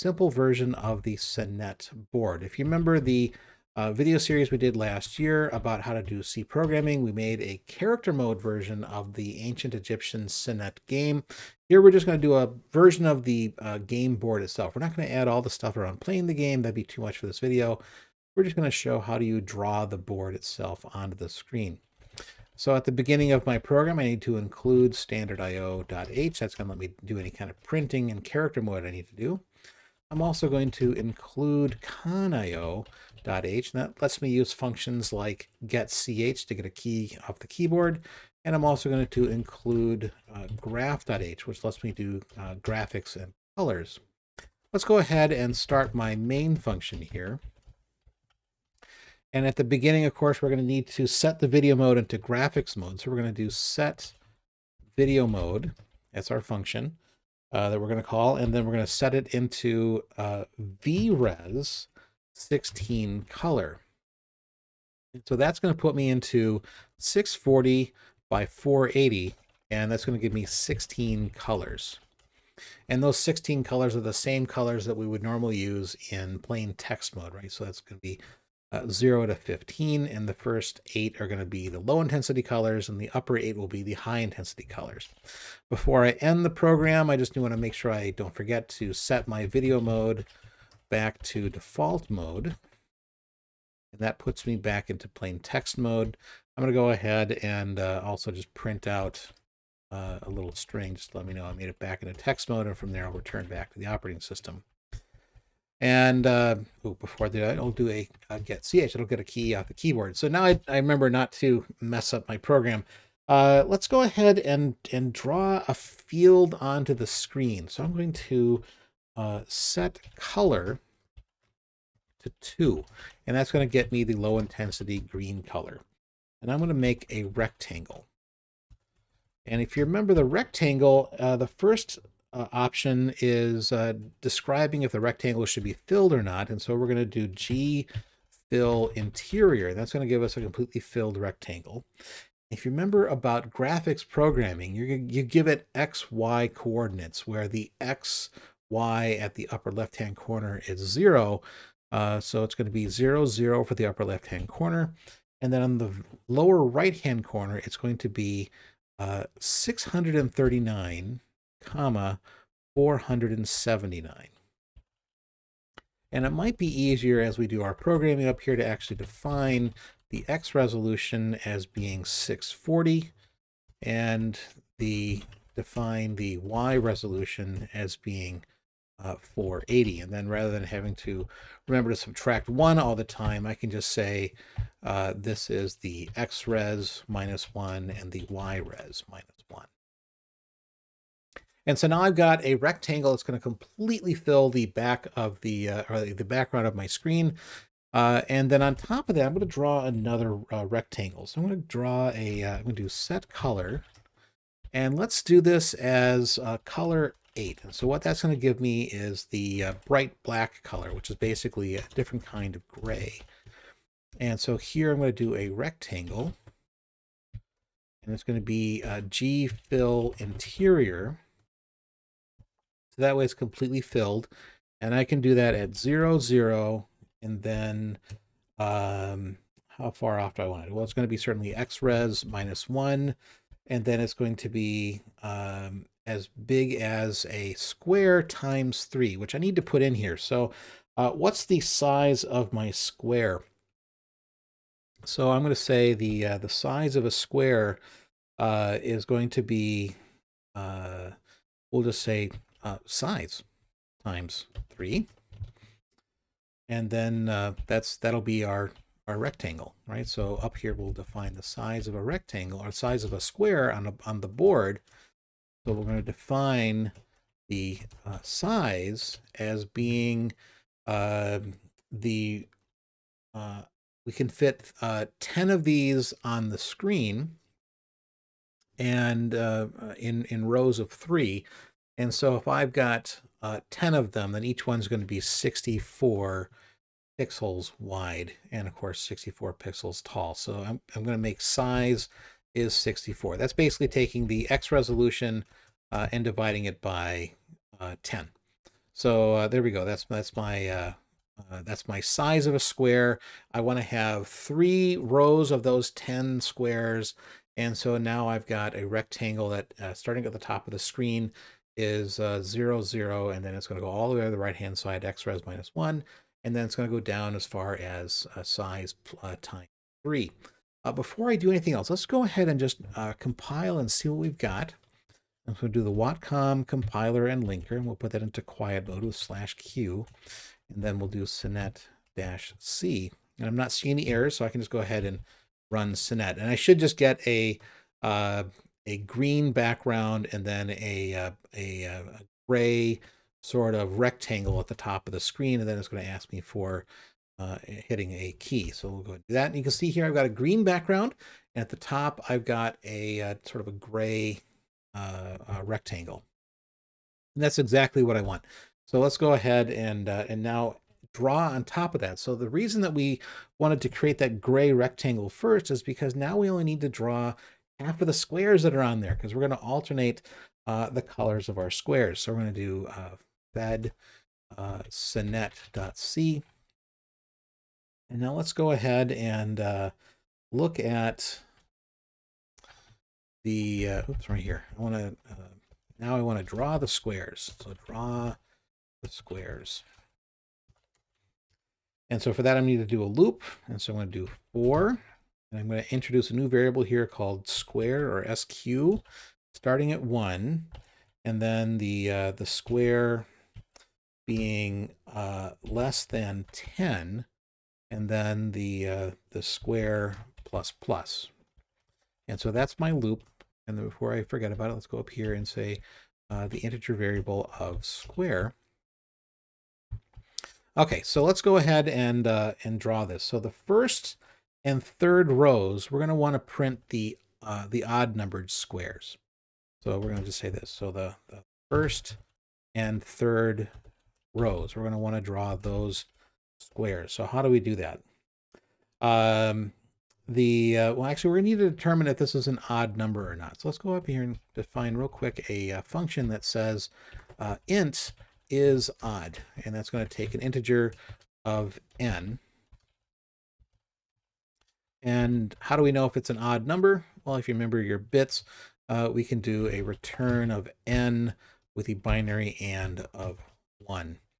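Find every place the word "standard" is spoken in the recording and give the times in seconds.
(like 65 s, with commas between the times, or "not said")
24 s.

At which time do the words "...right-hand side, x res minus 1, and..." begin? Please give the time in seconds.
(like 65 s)
314 s.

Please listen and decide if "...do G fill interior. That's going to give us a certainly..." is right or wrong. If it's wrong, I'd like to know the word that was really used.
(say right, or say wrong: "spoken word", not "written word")
wrong: "completely", not "certainly".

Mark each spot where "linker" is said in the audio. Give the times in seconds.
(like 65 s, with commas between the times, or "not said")
327 s.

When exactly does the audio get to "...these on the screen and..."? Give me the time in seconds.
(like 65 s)
275 s.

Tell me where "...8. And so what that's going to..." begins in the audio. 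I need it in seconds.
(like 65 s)
207 s.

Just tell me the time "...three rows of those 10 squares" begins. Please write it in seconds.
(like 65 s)
304 s.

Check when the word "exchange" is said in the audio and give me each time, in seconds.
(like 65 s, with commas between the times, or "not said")
not said.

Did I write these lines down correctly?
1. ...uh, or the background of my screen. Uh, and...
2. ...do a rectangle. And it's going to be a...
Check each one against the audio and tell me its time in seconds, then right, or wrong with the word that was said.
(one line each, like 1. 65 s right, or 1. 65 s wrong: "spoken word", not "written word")
1. 195 s right
2. 215 s right.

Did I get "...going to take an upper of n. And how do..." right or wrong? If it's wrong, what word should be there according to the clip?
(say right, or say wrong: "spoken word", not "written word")
wrong: "integer", not "upper".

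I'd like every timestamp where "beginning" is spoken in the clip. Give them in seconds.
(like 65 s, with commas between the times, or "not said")
22 s, 49 s.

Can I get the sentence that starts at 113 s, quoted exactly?
Uh, let's go ahead and, and draw a field onto the screen.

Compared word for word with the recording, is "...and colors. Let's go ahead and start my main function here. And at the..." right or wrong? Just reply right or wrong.
right.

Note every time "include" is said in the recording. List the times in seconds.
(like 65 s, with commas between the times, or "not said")
24 s, 30 s, 39 s.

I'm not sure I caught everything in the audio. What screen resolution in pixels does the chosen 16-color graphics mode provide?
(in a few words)
640 by 480.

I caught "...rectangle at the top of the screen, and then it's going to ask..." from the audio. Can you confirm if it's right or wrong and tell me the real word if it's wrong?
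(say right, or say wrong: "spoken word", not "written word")
right.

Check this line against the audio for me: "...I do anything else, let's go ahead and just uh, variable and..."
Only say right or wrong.
wrong.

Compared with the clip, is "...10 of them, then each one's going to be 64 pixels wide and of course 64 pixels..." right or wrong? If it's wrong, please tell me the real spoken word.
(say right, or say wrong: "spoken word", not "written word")
right.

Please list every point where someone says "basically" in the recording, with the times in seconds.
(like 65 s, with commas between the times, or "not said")
211 s, 293 s.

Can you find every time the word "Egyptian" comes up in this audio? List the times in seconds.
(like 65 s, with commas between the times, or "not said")
9 s.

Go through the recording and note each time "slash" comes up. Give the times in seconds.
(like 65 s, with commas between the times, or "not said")
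329 s.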